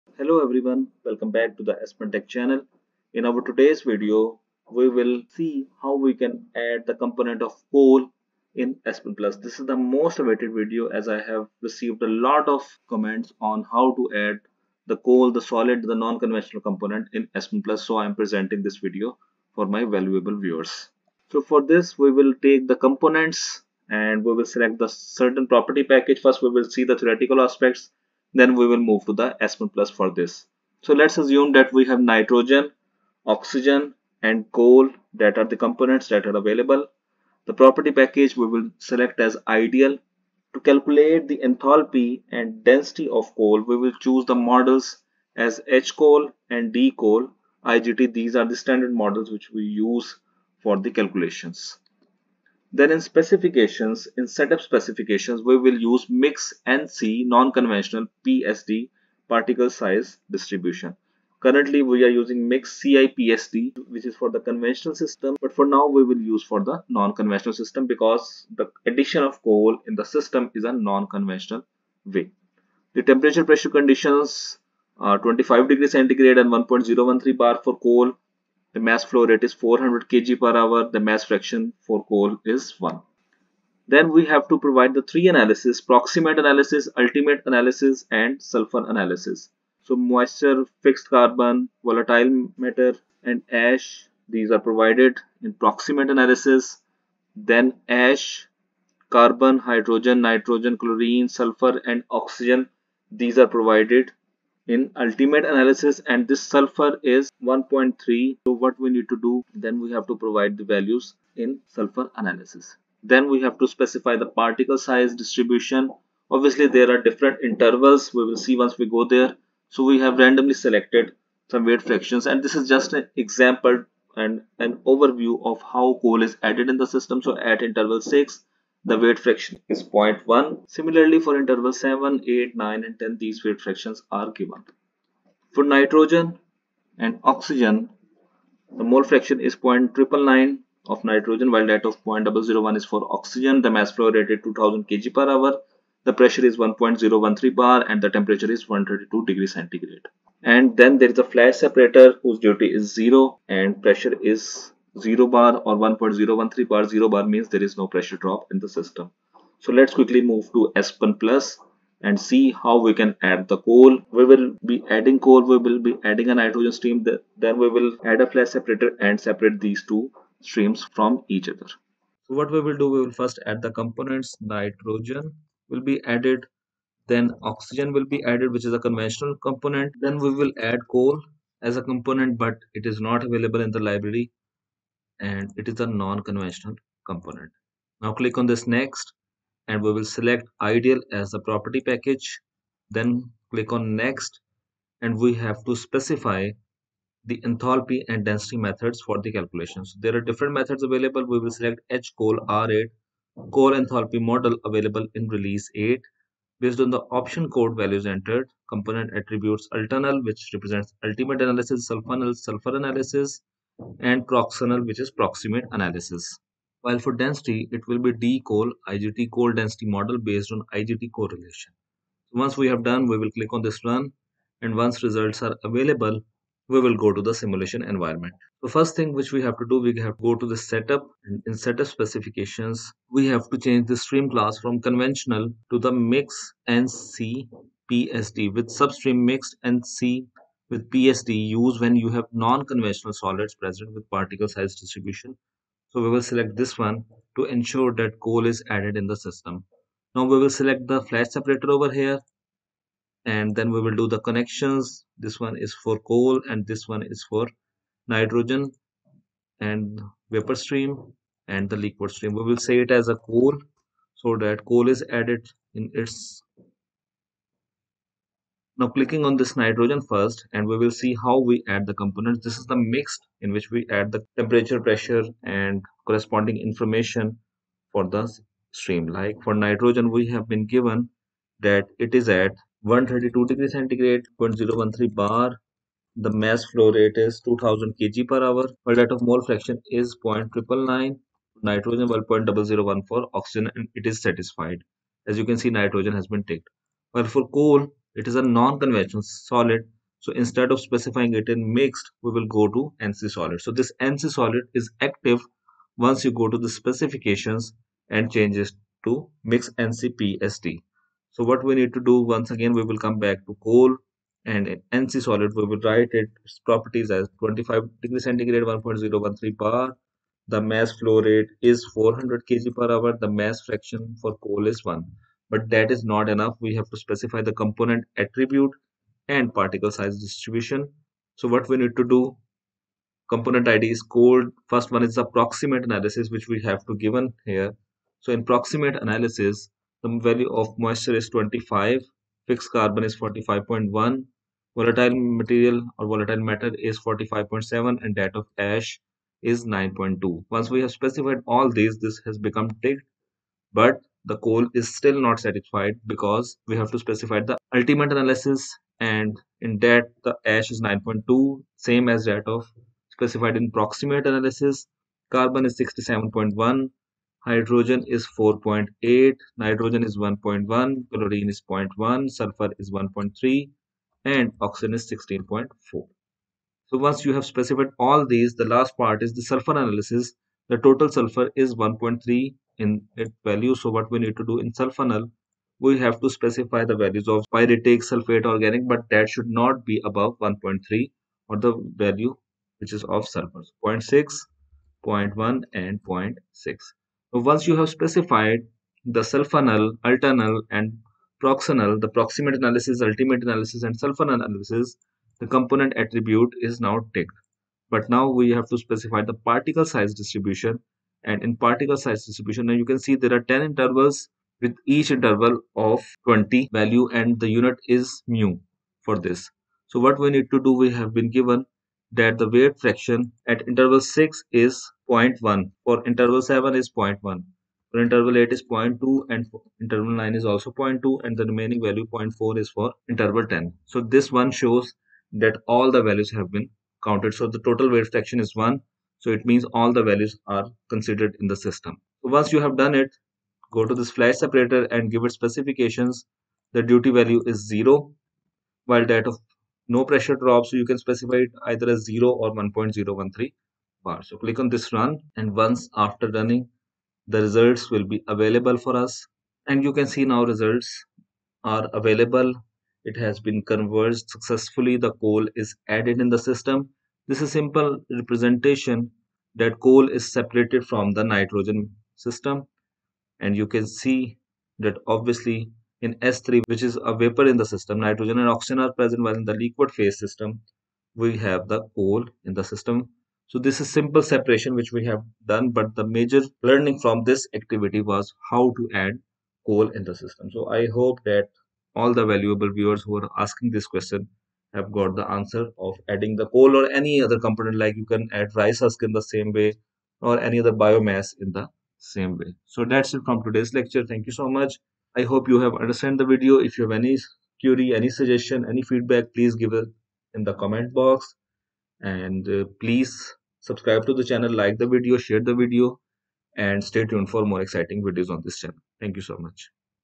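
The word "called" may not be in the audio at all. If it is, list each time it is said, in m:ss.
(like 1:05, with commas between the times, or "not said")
5:34.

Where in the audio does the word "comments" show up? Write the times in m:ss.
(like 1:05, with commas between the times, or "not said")
0:12, 8:30.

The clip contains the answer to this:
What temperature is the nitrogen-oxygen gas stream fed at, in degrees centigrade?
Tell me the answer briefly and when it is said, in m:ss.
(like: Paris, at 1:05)
132, at 2:28.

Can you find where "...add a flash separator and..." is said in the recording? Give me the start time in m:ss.
2:48.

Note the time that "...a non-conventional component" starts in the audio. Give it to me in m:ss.
3:05.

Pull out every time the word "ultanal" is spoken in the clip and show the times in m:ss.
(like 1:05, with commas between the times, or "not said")
3:29, 6:40.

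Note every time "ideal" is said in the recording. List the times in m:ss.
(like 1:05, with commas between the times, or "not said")
0:39, 3:10.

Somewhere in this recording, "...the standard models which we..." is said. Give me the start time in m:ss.
0:48.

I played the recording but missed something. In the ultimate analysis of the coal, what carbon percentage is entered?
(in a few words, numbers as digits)
67.1.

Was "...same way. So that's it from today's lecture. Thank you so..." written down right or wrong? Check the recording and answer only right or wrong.
right.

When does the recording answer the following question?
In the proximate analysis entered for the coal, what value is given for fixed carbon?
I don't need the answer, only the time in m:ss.
5:43.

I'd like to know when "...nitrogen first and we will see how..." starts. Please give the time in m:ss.
4:29.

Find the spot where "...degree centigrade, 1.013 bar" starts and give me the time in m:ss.
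5:18.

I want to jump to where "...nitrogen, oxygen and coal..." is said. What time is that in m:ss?
0:31.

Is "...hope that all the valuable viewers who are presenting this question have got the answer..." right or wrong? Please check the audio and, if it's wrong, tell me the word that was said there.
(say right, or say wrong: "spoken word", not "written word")
wrong: "asking", not "presenting".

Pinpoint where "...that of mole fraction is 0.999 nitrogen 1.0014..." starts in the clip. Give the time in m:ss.
4:48.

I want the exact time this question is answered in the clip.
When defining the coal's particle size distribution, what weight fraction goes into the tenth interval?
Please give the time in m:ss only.
7:12.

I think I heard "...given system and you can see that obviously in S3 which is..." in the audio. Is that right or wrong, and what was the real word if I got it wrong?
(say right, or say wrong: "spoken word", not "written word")
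wrong: "nitrogen", not "given".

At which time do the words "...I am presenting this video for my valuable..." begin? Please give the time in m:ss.
0:17.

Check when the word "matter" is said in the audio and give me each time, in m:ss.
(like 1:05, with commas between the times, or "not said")
1:32, 5:46.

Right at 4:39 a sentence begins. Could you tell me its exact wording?
Like for nitrogen we have been given that it is at 132 degree centigrade 0.013 bar.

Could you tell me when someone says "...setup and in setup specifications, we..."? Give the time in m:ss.
3:50.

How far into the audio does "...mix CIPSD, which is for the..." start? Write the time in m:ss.
1:02.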